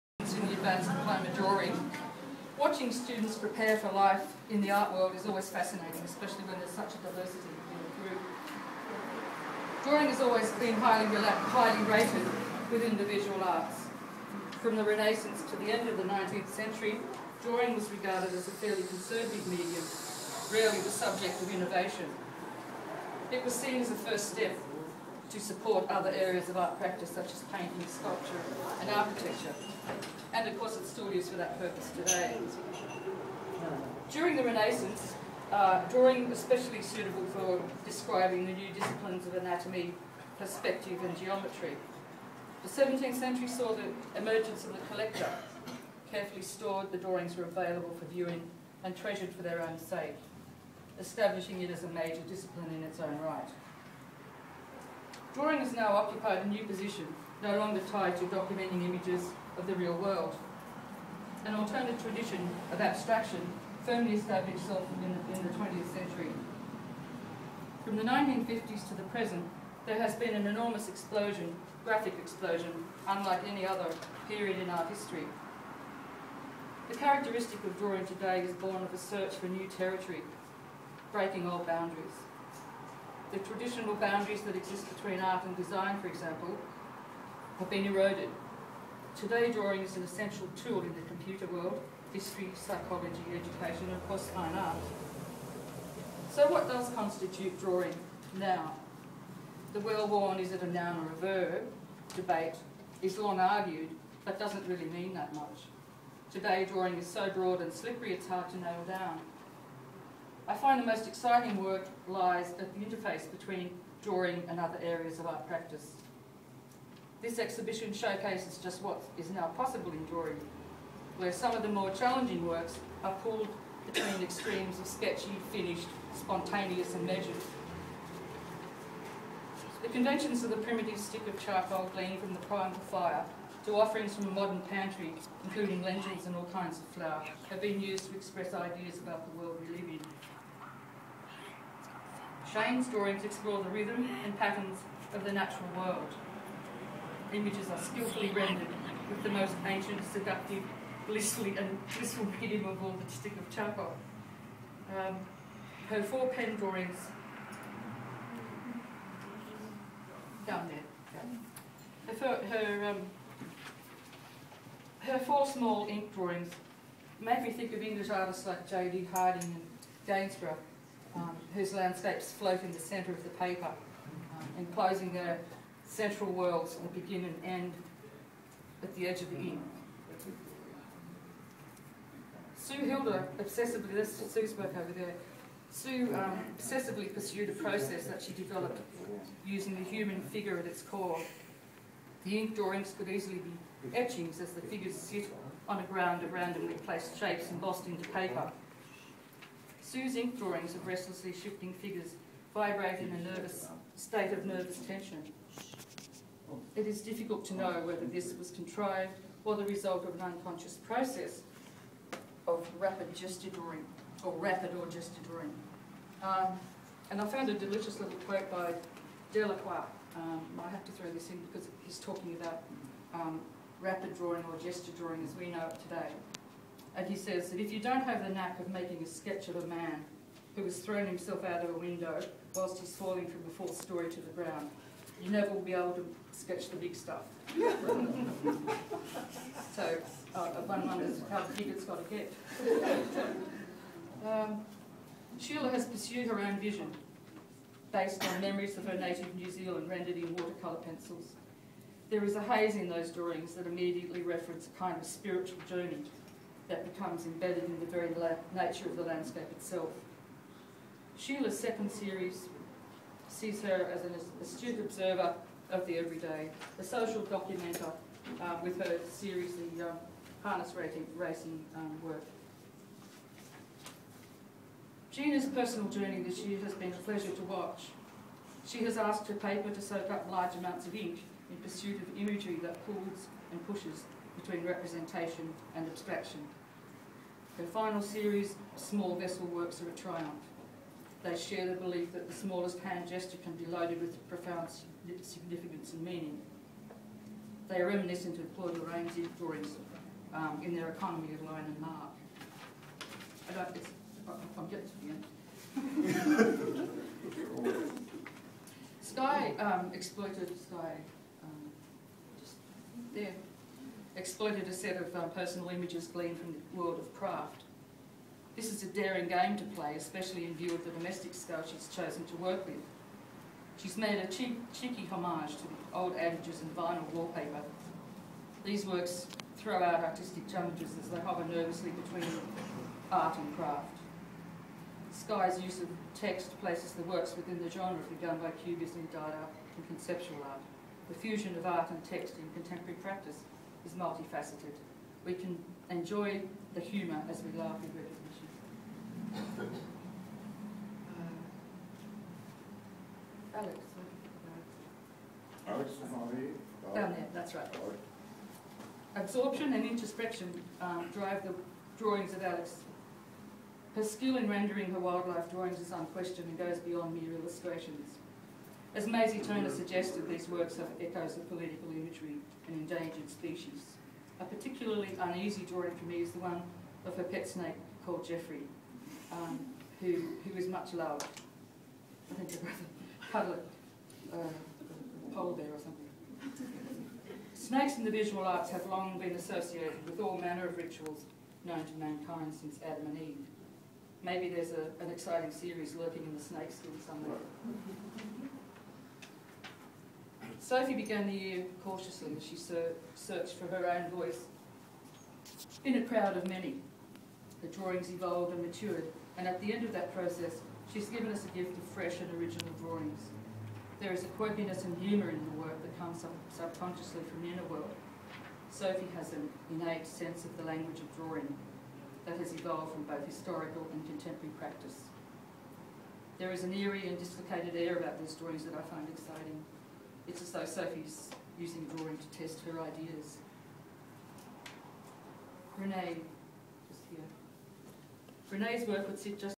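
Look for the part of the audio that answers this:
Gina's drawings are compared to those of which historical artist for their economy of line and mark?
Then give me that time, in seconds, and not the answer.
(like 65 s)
298 s.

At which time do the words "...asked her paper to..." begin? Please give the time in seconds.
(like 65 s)
278 s.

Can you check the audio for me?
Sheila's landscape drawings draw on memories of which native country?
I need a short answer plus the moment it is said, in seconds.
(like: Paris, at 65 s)
New Zealand, at 249 s.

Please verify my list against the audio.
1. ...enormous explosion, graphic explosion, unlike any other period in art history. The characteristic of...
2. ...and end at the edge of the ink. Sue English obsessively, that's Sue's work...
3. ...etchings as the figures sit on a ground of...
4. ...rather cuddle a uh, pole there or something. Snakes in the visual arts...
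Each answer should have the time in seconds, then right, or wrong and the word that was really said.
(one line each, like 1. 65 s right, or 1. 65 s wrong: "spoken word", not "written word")
1. 70 s right
2. 177 s wrong: "Hilda", not "English"
3. 193 s right
4. 382 s right.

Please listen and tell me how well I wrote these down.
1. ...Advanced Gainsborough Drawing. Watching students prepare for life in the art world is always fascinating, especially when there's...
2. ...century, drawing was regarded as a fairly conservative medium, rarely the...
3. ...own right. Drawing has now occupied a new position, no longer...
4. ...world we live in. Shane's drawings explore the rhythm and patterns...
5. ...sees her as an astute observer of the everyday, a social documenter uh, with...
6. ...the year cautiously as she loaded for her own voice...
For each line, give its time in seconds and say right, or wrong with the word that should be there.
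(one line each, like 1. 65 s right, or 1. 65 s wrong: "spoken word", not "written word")
1. 0 s wrong: "Diploma", not "Gainsborough"
2. 16 s right
3. 52 s right
4. 139 s right
5. 263 s right
6. 401 s wrong: "searched", not "loaded".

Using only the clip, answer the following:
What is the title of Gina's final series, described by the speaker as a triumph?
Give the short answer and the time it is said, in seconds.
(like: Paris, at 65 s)
Small Vessel Works, at 288 s.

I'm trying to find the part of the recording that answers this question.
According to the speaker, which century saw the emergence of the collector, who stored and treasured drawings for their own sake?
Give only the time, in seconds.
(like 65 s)
42 s.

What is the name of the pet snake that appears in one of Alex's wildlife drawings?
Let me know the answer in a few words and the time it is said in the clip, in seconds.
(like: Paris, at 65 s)
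Jeffrey, at 378 s.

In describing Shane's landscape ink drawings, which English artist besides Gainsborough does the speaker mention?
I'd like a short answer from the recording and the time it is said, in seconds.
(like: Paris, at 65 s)
J.D. Harding, at 168 s.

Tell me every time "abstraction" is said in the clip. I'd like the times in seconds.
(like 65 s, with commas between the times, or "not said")
62 s, 285 s.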